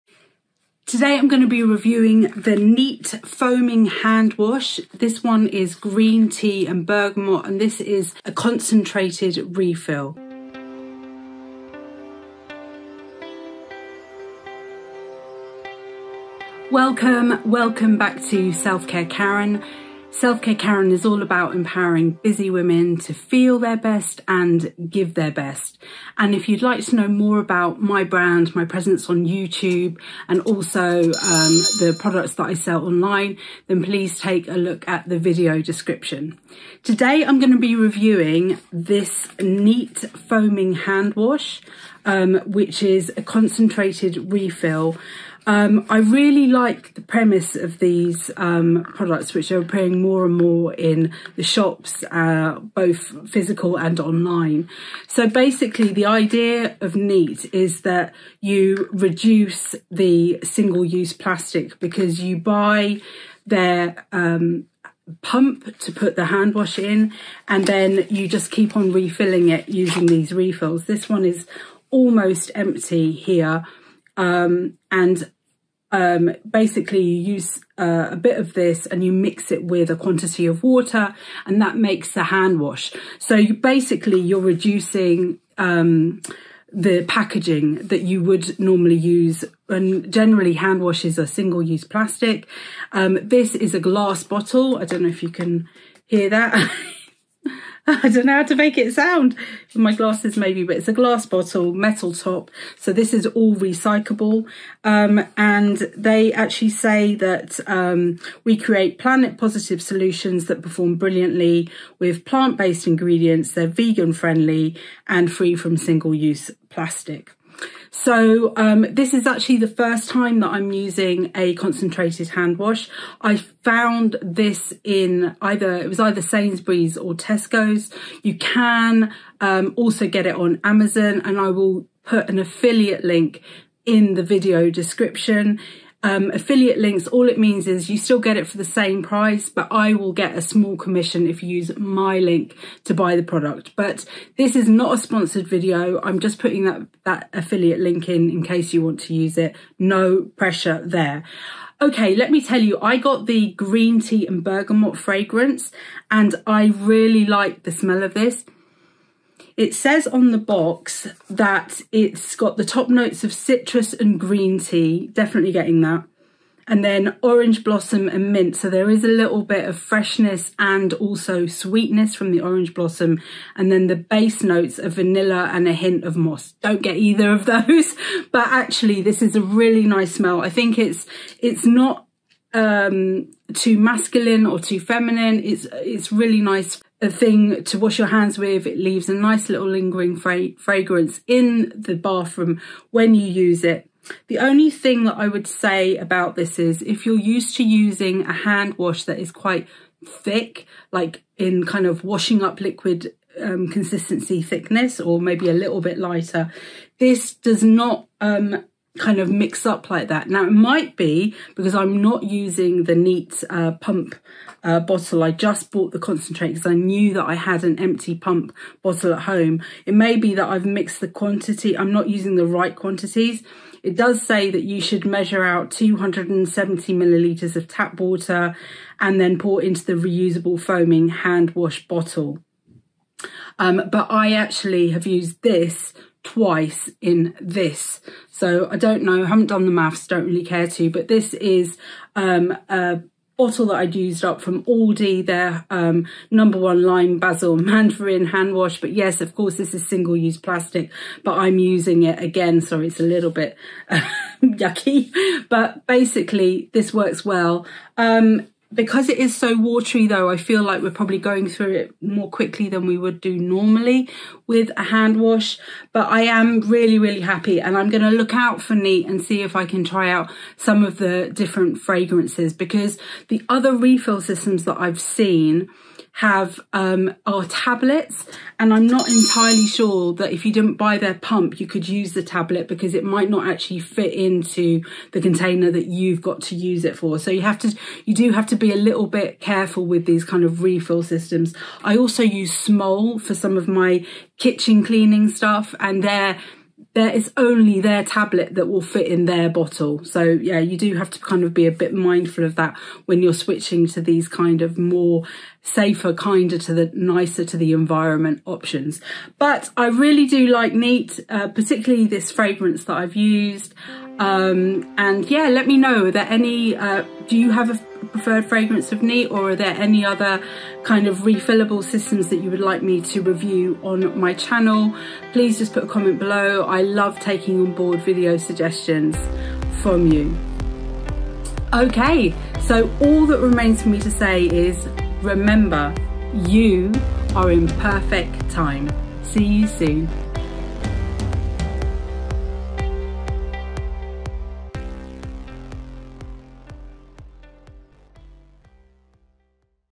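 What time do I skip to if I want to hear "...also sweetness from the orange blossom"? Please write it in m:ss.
2:50.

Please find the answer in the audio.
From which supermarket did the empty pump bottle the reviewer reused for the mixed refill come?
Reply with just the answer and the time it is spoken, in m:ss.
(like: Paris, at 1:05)
Aldi, at 4:04.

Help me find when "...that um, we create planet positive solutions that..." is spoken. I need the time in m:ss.
1:47.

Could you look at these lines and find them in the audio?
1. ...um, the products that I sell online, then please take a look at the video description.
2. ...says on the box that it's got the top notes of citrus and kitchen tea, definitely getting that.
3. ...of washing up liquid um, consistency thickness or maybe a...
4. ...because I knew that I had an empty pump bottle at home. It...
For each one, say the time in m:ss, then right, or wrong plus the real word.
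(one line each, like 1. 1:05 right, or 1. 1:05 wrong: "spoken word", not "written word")
1. 0:31 right
2. 2:39 wrong: "green", not "kitchen"
3. 3:21 right
4. 3:36 right.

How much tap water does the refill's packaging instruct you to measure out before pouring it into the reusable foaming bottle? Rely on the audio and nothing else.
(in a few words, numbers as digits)
270 millilitres.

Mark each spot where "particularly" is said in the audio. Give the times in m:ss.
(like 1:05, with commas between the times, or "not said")
5:11.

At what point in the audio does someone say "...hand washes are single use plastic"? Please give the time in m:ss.
1:30.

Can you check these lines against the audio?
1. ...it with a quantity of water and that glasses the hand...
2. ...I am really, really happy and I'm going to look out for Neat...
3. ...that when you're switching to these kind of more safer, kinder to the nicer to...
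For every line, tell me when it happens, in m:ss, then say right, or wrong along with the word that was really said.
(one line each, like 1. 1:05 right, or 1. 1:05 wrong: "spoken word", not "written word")
1. 1:19 wrong: "makes", not "glasses"
2. 4:26 right
3. 5:02 right.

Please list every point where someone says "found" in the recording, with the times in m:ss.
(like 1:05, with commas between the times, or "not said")
2:03.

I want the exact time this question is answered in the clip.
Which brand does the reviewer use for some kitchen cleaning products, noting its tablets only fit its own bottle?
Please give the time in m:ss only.
4:52.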